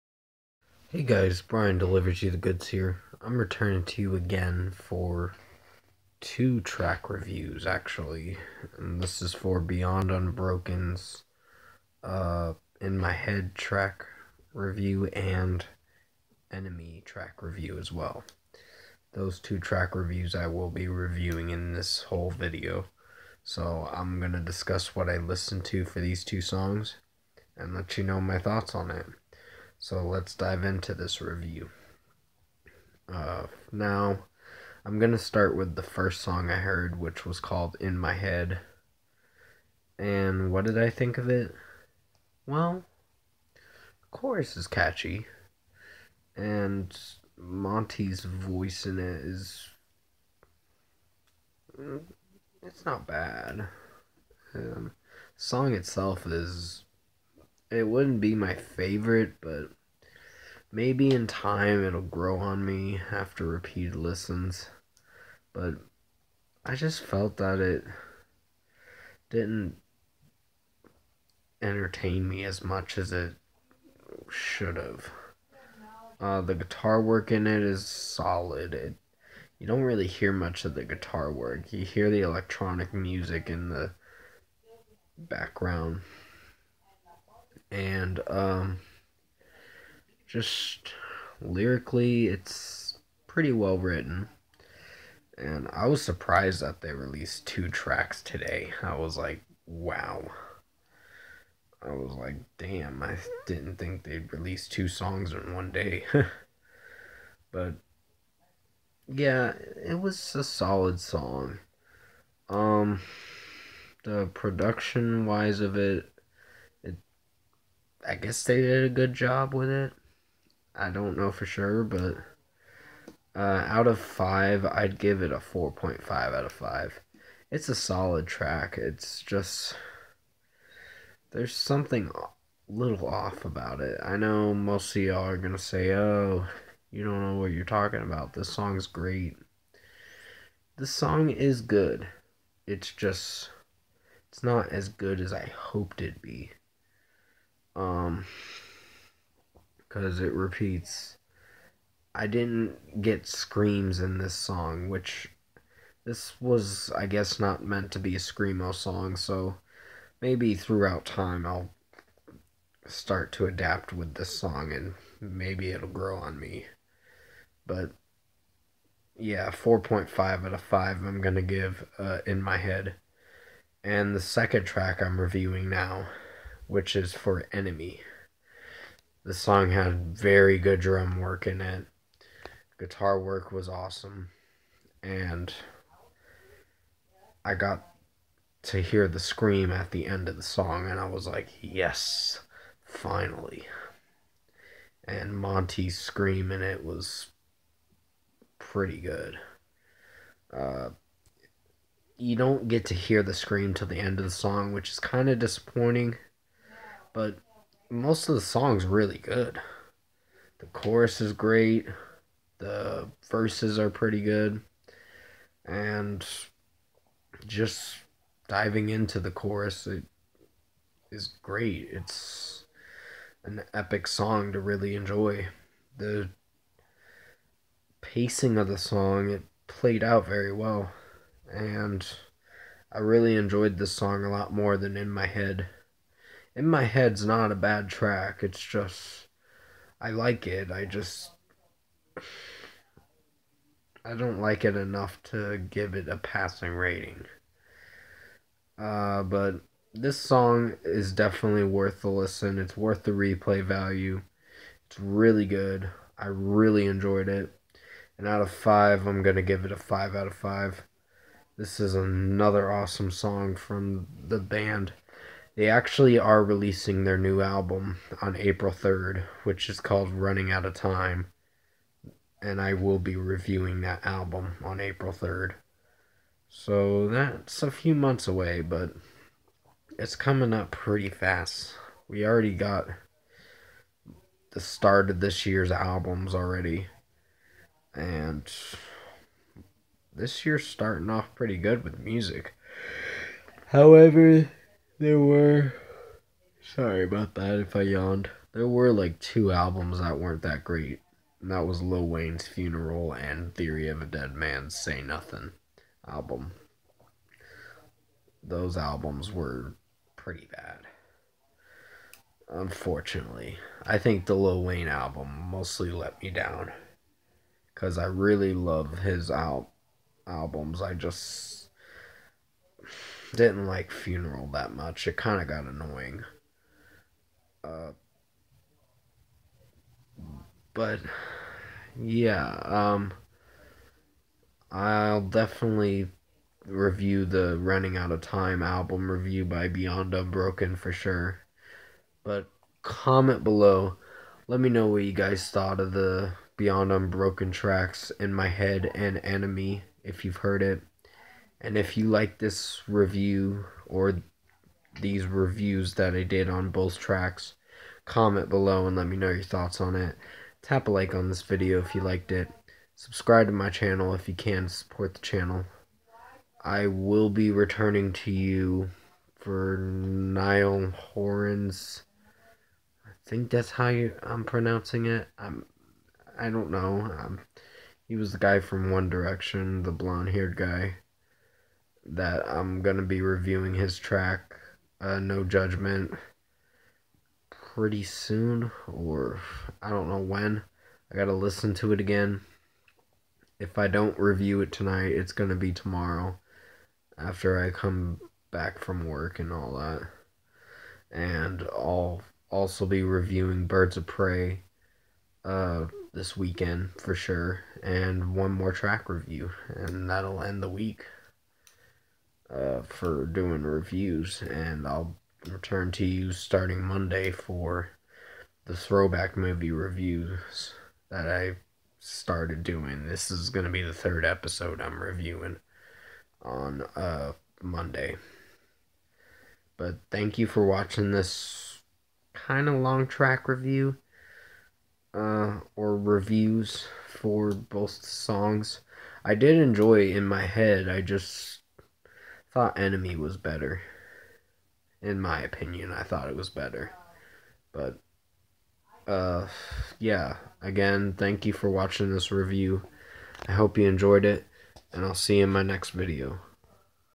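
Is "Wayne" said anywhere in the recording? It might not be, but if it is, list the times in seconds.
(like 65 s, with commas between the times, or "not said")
302 s, 314 s.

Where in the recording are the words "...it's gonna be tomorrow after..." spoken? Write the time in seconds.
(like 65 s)
395 s.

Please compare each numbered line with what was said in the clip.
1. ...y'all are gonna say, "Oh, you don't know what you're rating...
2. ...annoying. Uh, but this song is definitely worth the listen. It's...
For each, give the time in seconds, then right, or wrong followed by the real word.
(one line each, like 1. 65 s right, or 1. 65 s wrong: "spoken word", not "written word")
1. 135 s wrong: "talking", not "rating"
2. 246 s wrong: "rating", not "annoying".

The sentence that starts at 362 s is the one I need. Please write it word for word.
Subscribe to my channel if you can support the channel.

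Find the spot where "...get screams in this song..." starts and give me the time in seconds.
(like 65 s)
153 s.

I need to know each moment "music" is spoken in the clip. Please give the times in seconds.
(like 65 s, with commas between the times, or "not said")
82 s, 291 s.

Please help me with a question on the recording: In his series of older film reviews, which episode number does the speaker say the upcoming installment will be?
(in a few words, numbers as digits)
3.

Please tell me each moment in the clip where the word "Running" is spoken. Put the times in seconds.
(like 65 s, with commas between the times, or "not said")
270 s, 337 s.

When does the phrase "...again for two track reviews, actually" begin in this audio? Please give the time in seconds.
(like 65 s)
4 s.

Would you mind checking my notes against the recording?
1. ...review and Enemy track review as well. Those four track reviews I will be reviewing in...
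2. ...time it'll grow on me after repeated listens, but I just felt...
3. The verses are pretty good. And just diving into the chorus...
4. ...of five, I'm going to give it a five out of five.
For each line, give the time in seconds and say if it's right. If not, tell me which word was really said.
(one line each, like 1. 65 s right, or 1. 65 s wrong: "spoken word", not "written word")
1. 14 s wrong: "two", not "four"
2. 61 s right
3. 212 s right
4. 258 s right.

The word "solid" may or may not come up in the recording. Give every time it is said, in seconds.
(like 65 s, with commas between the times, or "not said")
77 s, 110 s, 127 s.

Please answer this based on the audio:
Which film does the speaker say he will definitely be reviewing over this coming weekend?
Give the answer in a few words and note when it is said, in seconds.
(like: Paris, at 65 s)
Birds of Prey, at 403 s.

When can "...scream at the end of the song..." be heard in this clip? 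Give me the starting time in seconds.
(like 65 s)
189 s.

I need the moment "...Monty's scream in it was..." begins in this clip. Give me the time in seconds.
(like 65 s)
195 s.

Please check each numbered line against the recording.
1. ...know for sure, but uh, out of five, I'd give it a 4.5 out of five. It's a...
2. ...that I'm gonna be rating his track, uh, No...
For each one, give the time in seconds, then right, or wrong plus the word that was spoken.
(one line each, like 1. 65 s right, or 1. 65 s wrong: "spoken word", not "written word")
1. 121 s right
2. 382 s wrong: "reviewing", not "rating".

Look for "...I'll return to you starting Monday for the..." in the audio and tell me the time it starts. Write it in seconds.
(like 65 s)
414 s.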